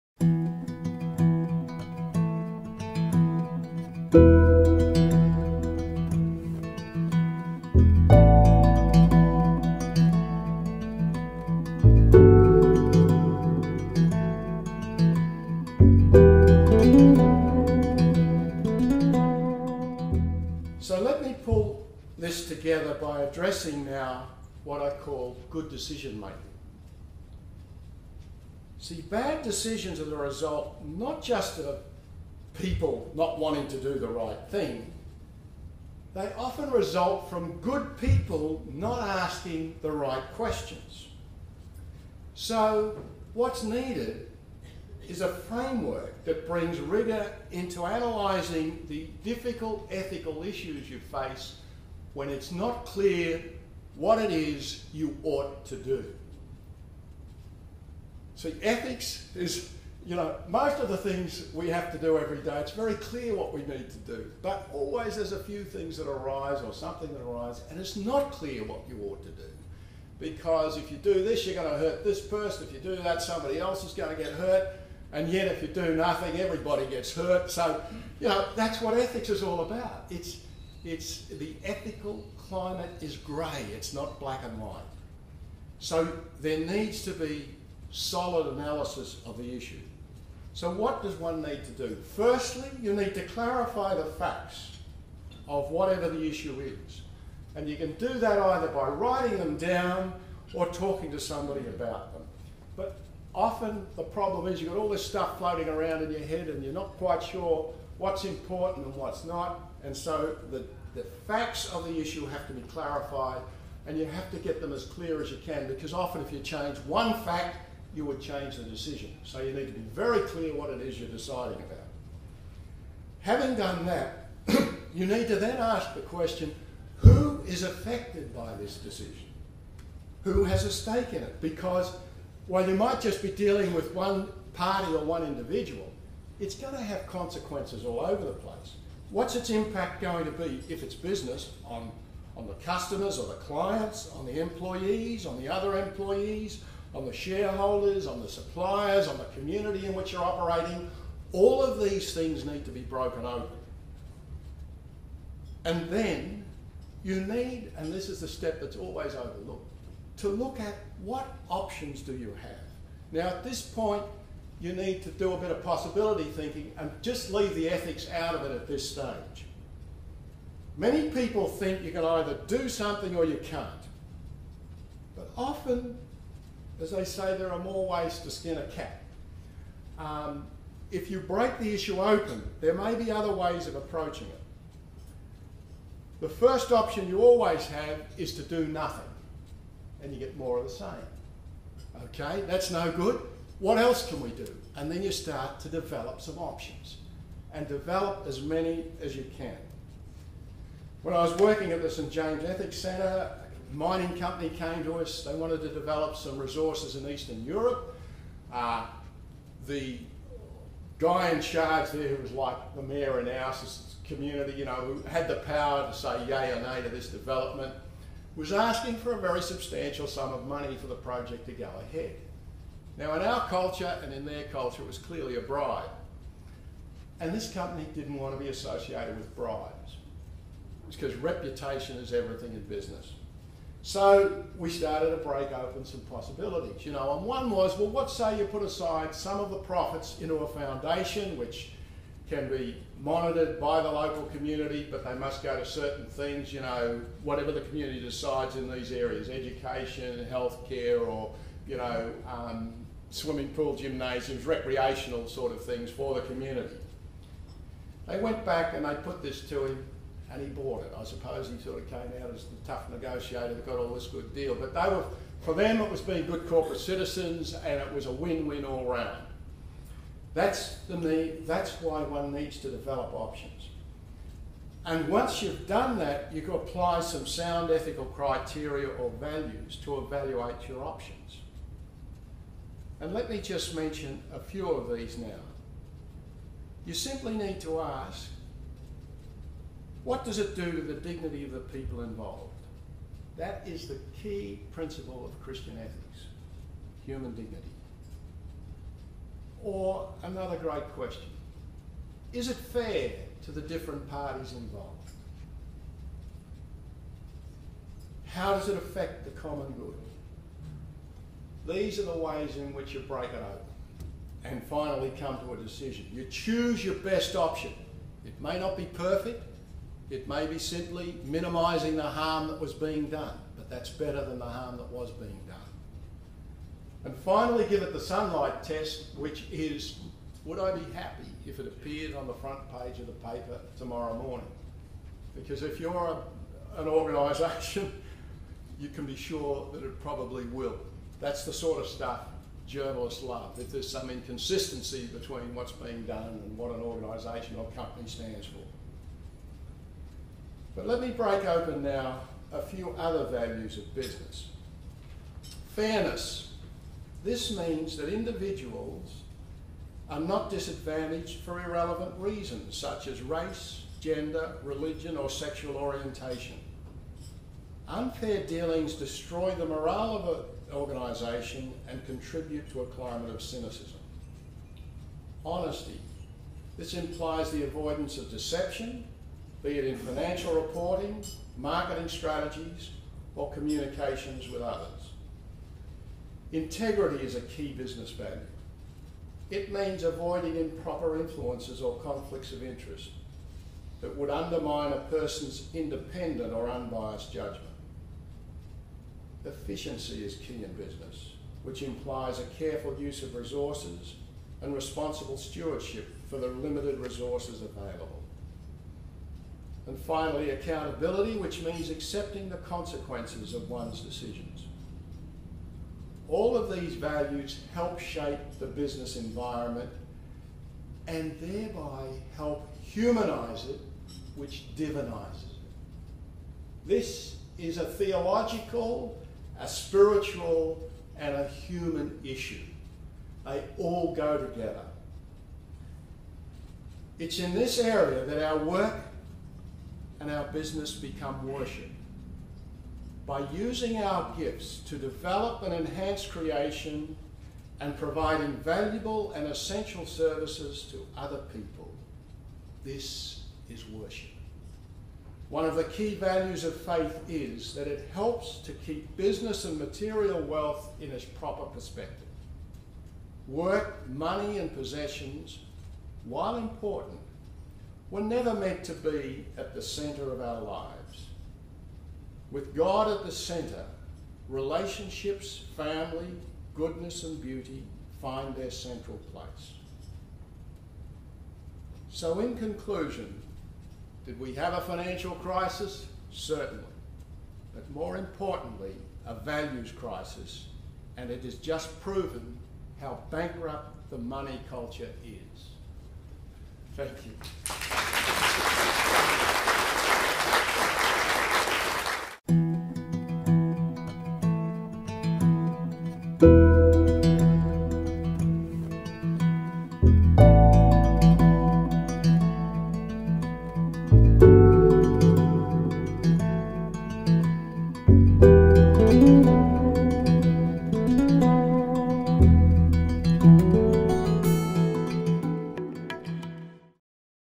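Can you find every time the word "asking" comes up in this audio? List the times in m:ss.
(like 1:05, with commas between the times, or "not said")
0:39, 3:38.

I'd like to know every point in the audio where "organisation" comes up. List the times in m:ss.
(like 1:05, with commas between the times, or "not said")
5:36, 5:46, 6:10.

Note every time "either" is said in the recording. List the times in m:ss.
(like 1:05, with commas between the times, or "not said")
1:38, 2:52.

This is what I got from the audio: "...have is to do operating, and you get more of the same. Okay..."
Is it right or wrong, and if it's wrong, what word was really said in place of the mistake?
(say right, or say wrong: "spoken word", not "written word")
wrong: "nothing", not "operating".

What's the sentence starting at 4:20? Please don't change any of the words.
I suppose he sort of came out as the tough negotiator that got all this good deal.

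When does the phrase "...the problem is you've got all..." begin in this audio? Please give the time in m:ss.
1:43.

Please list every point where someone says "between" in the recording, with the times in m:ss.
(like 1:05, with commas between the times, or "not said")
5:45.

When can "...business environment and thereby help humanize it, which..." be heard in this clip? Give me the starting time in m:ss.
6:58.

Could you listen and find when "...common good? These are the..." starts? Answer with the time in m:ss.
5:09.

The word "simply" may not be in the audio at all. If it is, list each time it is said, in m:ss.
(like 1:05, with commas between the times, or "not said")
4:46, 5:20.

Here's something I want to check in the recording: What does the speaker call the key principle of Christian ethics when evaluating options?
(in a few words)
Human dignity.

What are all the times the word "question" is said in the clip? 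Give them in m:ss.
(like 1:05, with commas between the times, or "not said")
0:40, 2:06, 5:00.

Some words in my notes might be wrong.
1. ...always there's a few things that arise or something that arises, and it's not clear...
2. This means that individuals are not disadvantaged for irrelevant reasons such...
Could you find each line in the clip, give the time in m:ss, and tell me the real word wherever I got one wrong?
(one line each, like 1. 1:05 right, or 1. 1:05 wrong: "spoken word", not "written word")
1. 1:04 right
2. 5:57 right.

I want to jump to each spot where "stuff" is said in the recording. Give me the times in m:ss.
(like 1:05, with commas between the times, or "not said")
1:45, 5:41.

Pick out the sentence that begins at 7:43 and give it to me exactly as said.
Work, money, and possessions, while important, we're never meant to be at the center of our lives.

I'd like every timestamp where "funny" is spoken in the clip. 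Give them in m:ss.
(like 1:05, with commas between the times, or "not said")
not said.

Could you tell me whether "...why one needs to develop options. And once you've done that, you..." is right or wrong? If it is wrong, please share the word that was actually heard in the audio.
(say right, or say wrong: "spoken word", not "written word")
right.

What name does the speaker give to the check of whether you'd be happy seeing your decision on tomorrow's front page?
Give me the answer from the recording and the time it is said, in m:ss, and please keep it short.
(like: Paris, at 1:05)
Sunlight test, at 5:27.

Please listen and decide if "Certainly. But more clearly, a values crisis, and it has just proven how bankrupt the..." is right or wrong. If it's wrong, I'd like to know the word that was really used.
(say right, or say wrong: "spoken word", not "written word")
wrong: "importantly", not "clearly".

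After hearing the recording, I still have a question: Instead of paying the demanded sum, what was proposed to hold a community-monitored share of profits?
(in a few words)
A foundation.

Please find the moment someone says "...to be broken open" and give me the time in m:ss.
2:32.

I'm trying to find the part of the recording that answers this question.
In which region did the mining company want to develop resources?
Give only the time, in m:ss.
3:27.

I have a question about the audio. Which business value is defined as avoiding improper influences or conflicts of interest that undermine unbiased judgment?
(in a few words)
Integrity.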